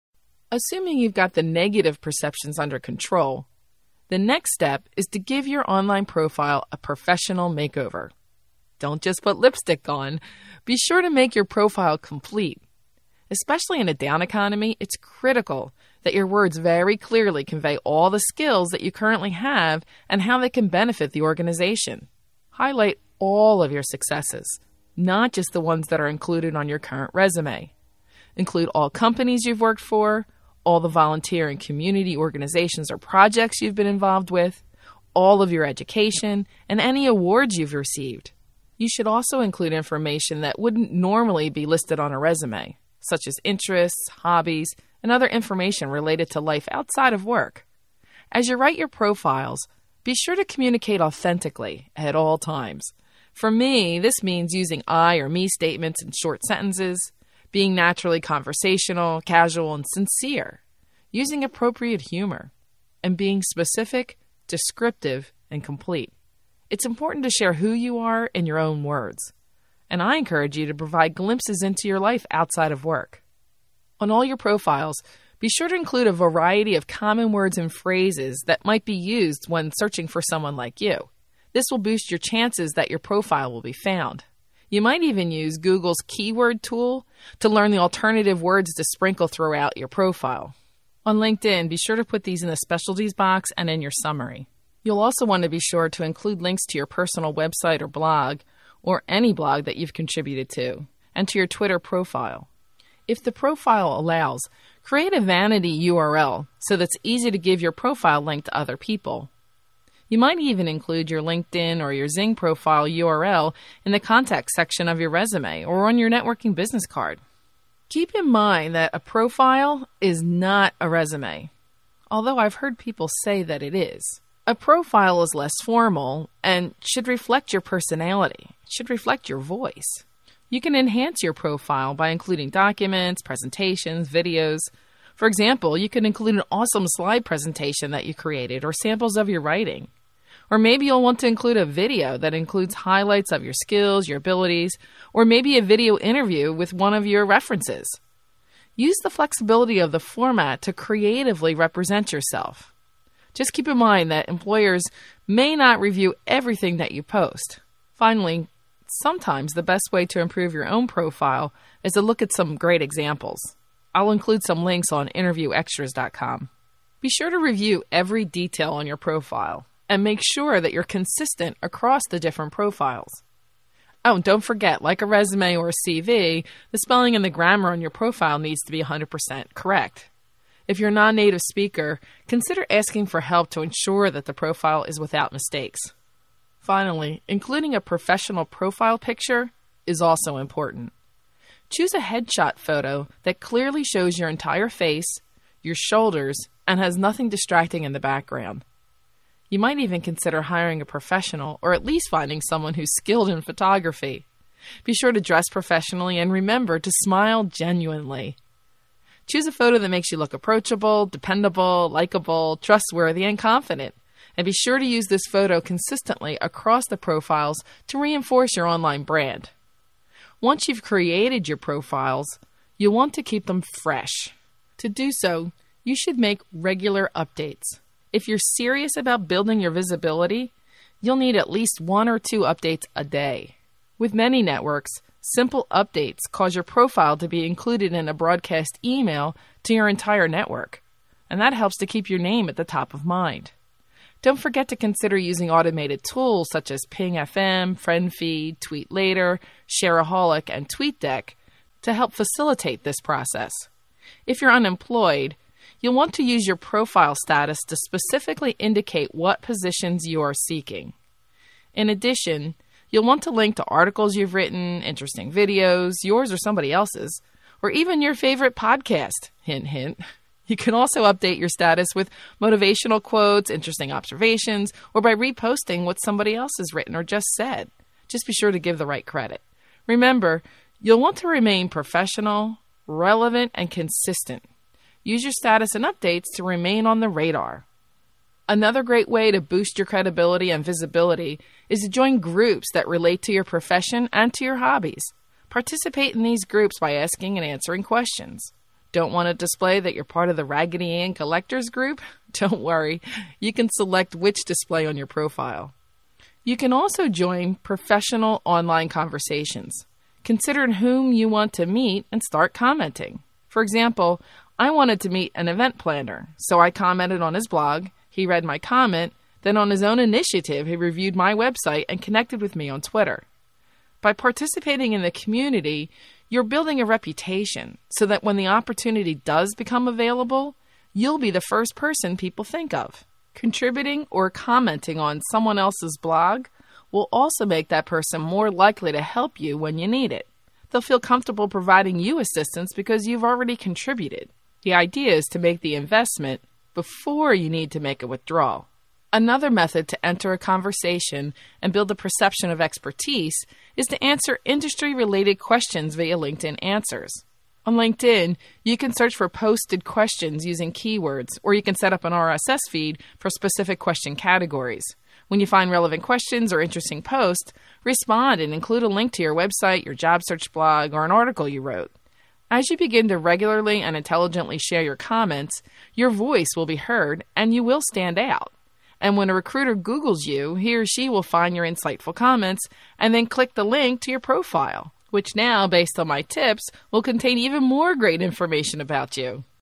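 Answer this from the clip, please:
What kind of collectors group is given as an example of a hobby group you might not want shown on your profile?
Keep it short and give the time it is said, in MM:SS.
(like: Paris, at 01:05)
Raggedy Ann, at 05:00.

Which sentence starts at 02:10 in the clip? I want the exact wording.
You can enhance your profile by including documents, presentations, videos.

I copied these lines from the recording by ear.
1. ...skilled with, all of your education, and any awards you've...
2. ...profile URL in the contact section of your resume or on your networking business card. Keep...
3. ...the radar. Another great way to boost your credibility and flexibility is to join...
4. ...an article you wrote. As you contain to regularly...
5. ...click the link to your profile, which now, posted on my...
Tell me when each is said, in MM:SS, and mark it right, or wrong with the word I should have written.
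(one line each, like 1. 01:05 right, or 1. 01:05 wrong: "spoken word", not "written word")
1. 00:33 wrong: "involved", not "skilled"
2. 01:52 right
3. 04:46 wrong: "visibility", not "flexibility"
4. 06:11 wrong: "begin", not "contain"
5. 06:23 wrong: "based", not "posted".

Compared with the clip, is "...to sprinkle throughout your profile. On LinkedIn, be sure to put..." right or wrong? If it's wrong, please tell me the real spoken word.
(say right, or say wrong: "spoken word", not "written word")
right.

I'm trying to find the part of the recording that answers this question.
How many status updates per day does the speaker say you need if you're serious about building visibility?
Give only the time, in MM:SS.
03:51.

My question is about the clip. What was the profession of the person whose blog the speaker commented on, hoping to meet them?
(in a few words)
event planner.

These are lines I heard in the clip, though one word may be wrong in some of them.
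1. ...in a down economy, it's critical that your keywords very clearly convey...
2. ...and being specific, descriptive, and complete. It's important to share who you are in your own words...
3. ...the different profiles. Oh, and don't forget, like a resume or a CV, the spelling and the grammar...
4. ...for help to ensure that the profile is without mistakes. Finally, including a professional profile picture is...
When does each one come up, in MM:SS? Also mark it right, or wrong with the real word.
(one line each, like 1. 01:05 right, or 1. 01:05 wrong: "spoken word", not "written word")
1. 00:13 wrong: "words", not "keywords"
2. 01:03 right
3. 02:52 right
4. 03:03 right.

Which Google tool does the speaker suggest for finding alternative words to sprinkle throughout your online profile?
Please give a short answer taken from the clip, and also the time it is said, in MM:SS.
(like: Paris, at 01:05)
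Google's keyword tool, at 01:25.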